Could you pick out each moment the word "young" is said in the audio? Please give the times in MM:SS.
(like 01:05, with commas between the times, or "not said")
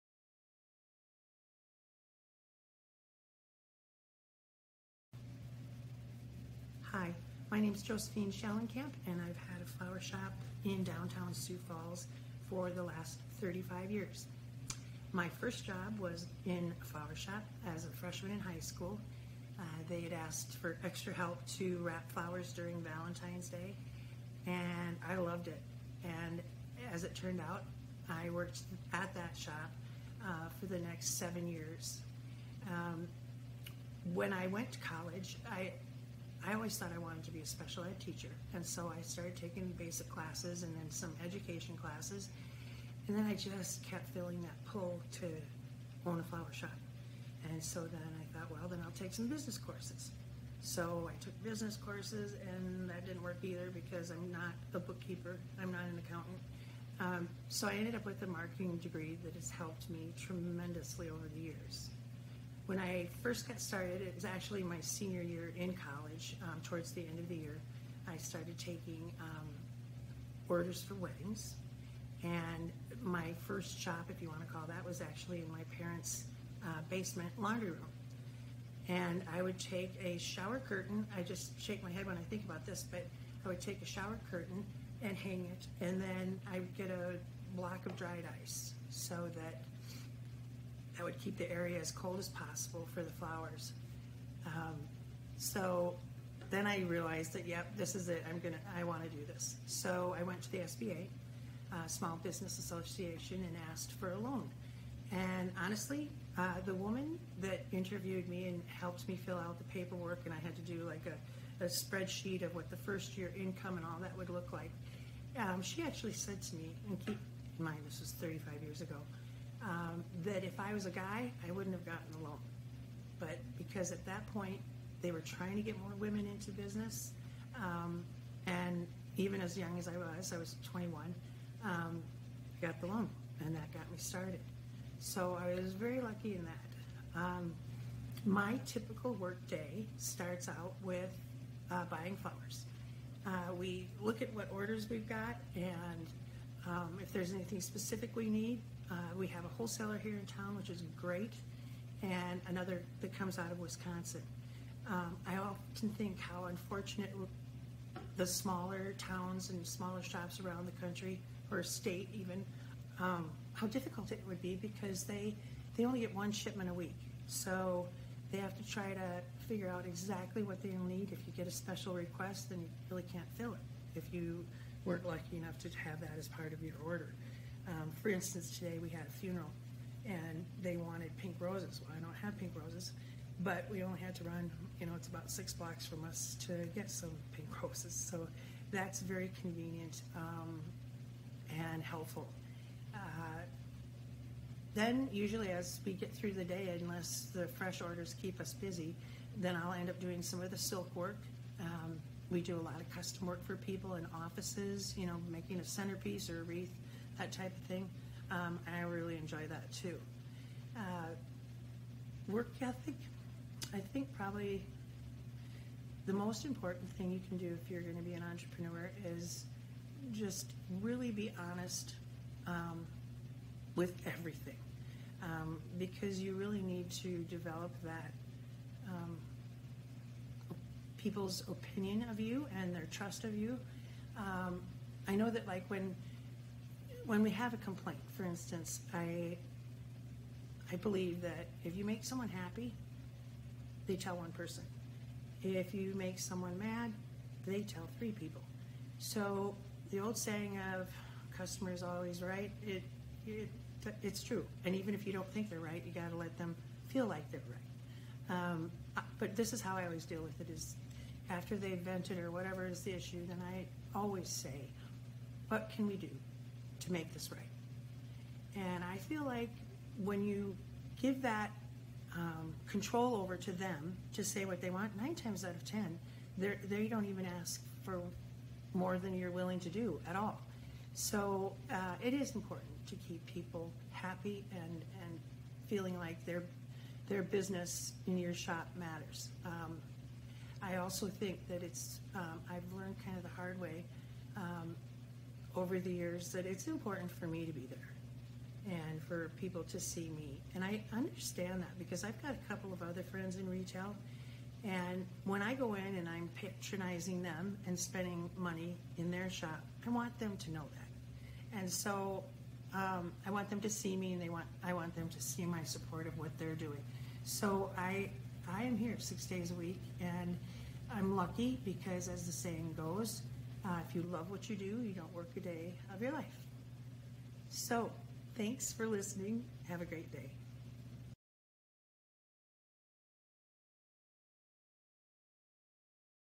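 02:09.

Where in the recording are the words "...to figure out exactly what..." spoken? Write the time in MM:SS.
02:48.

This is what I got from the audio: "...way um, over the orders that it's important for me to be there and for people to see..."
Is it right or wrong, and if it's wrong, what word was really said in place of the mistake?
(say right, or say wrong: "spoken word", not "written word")
wrong: "years", not "orders".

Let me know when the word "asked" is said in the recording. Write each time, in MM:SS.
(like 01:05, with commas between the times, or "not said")
00:20, 01:43.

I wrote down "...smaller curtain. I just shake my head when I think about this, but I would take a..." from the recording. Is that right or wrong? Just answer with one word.
wrong.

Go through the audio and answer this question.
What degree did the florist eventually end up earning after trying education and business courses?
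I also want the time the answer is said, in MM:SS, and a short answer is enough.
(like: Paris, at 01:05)
Marketing, at 00:58.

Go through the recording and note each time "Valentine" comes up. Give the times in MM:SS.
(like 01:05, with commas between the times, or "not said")
00:22.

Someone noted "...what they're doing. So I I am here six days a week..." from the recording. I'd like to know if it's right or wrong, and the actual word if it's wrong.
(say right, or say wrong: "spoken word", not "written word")
right.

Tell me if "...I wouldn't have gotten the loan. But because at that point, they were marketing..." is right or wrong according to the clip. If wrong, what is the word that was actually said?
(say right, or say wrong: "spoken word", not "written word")
wrong: "trying", not "marketing".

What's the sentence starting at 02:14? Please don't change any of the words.
So I was very lucky in that.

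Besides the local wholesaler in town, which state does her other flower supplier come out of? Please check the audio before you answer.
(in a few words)
Wisconsin.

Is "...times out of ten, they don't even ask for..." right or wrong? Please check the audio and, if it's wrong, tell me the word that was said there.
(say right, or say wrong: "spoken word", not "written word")
right.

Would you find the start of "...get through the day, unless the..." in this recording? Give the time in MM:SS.
03:15.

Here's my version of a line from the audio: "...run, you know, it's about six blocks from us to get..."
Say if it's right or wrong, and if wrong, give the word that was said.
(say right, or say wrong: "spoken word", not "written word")
right.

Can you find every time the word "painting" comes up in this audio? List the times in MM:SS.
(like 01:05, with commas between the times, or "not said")
not said.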